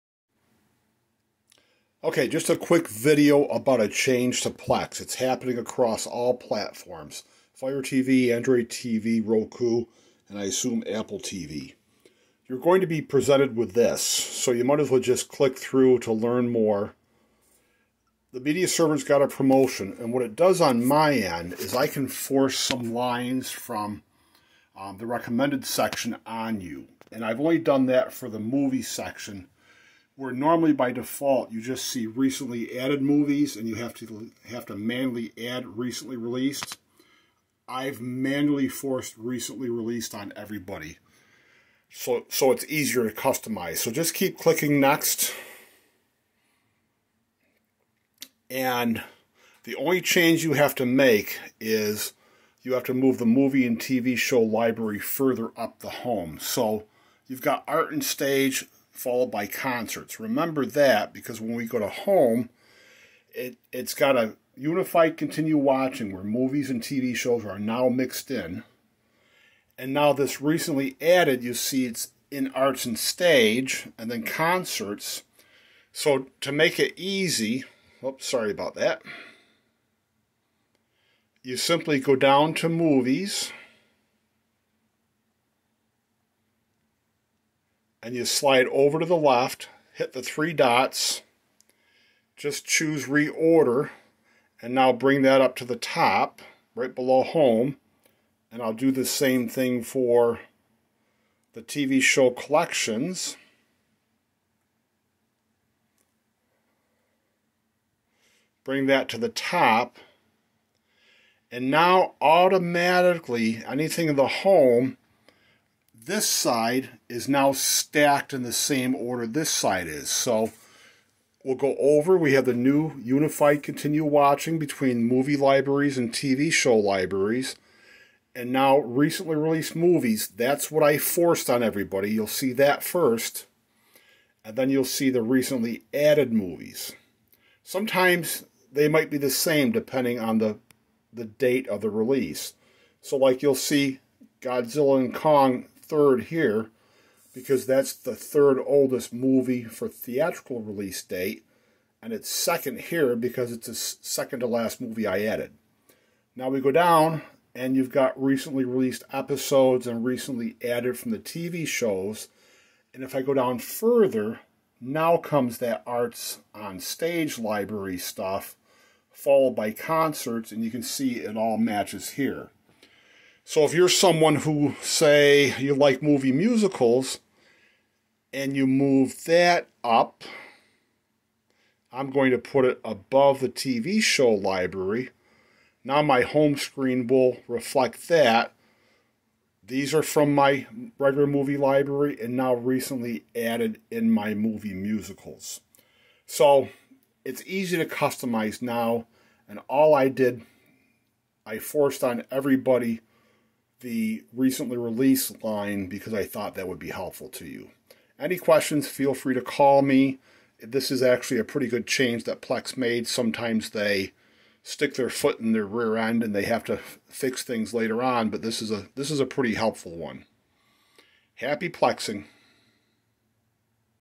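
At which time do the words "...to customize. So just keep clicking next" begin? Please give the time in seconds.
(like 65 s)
43 s.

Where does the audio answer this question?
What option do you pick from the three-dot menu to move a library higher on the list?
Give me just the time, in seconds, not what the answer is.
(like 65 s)
93 s.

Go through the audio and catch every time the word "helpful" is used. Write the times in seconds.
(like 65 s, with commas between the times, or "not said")
206 s, 219 s.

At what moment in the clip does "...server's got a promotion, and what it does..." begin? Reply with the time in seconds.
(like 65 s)
18 s.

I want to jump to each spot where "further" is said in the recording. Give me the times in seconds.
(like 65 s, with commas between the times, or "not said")
54 s, 163 s.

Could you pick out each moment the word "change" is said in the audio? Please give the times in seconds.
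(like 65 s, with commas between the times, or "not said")
3 s, 50 s, 211 s.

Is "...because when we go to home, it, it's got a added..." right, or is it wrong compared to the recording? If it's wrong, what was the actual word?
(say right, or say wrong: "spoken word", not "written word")
wrong: "unified", not "added".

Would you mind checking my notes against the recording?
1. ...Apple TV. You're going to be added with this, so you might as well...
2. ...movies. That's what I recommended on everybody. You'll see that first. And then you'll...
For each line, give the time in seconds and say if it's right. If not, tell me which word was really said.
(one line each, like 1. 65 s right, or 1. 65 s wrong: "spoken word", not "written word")
1. 10 s wrong: "presented", not "added"
2. 129 s wrong: "forced", not "recommended".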